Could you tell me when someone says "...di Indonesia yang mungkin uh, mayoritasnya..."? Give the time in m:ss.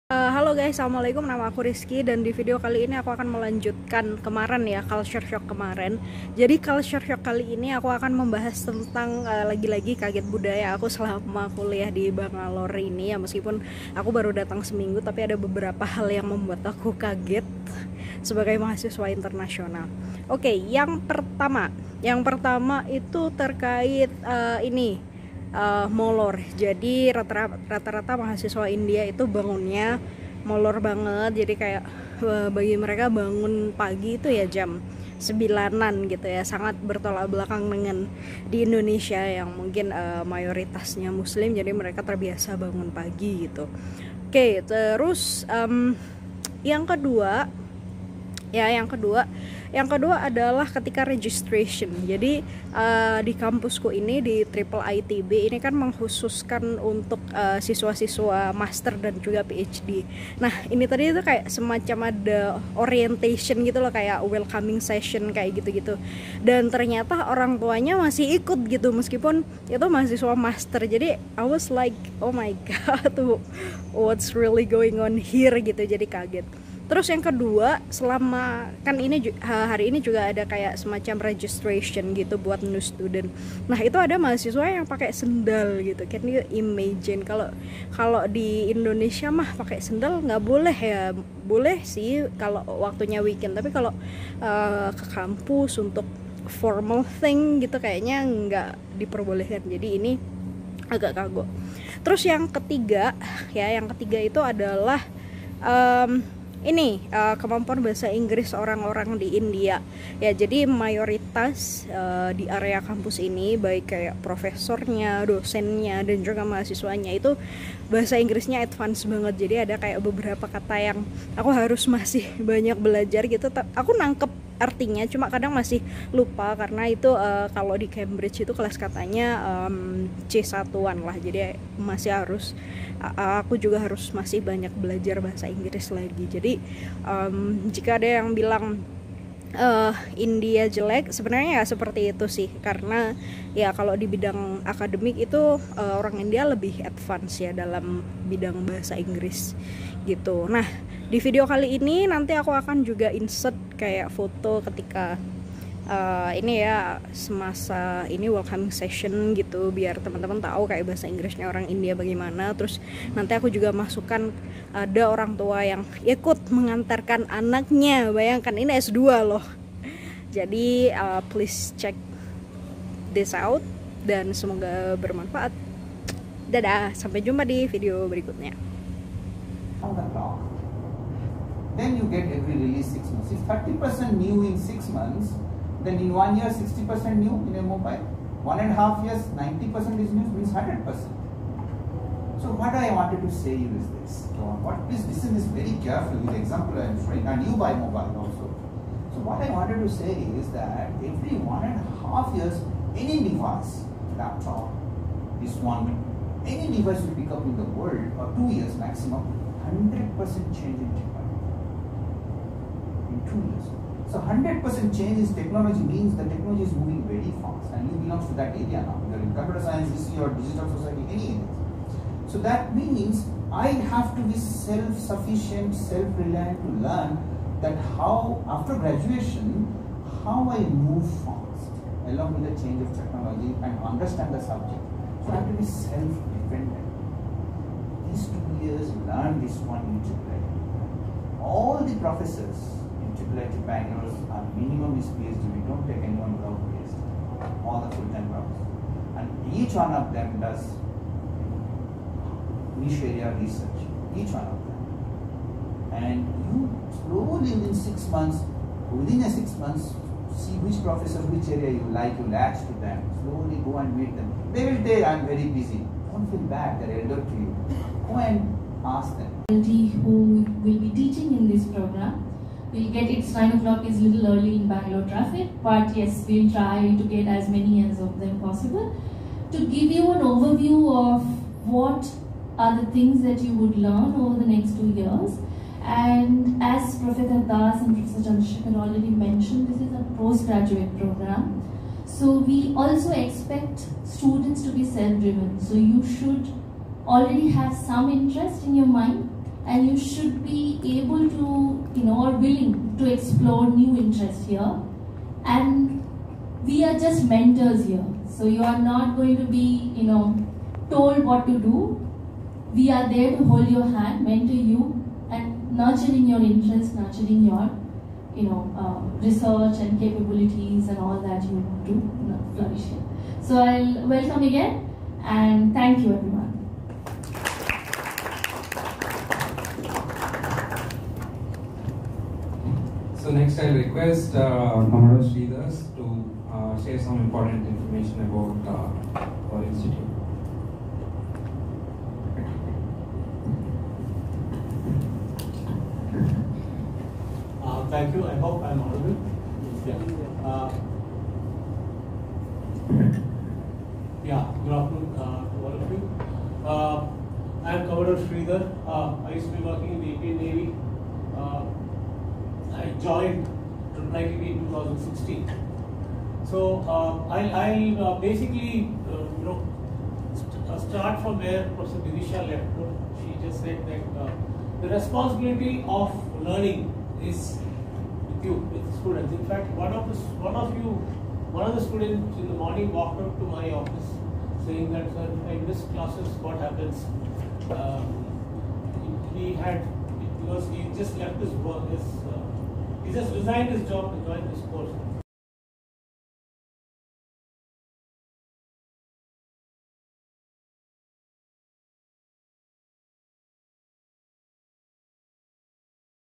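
0:38.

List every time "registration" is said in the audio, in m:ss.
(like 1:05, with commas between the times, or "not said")
0:51, 1:21.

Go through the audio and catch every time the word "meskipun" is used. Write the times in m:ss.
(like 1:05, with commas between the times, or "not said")
0:13, 1:08.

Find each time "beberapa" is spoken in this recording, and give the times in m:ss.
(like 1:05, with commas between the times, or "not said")
0:15, 2:00.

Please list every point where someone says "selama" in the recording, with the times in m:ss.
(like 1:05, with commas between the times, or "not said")
0:10, 1:17.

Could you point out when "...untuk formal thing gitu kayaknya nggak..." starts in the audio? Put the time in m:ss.
1:35.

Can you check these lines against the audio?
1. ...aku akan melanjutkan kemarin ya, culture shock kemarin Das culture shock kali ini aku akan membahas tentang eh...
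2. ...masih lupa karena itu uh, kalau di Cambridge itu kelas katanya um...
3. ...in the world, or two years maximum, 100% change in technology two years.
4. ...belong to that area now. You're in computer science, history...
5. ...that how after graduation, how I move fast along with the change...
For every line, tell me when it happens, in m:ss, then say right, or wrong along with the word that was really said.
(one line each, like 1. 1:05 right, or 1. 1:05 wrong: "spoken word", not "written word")
1. 0:02 wrong: "Jadi", not "Das"
2. 2:05 right
3. 3:27 right
4. 3:38 right
5. 3:47 right.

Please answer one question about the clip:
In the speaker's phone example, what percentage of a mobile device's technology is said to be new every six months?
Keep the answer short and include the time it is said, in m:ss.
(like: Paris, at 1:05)
30%, at 3:03.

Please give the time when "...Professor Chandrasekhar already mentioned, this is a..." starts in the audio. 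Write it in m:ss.
4:47.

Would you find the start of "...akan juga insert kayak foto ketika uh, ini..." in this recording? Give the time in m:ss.
2:32.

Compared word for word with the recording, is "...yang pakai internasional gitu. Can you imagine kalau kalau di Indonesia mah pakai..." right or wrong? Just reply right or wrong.
wrong.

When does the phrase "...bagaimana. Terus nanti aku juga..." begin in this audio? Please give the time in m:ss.
2:41.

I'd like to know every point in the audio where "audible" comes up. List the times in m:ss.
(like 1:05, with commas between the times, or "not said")
5:48.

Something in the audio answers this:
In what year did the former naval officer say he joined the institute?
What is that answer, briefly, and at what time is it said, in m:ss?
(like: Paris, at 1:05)
2016, at 6:04.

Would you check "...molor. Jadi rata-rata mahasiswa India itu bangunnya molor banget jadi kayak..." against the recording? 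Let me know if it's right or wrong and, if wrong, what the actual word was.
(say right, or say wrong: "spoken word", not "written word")
right.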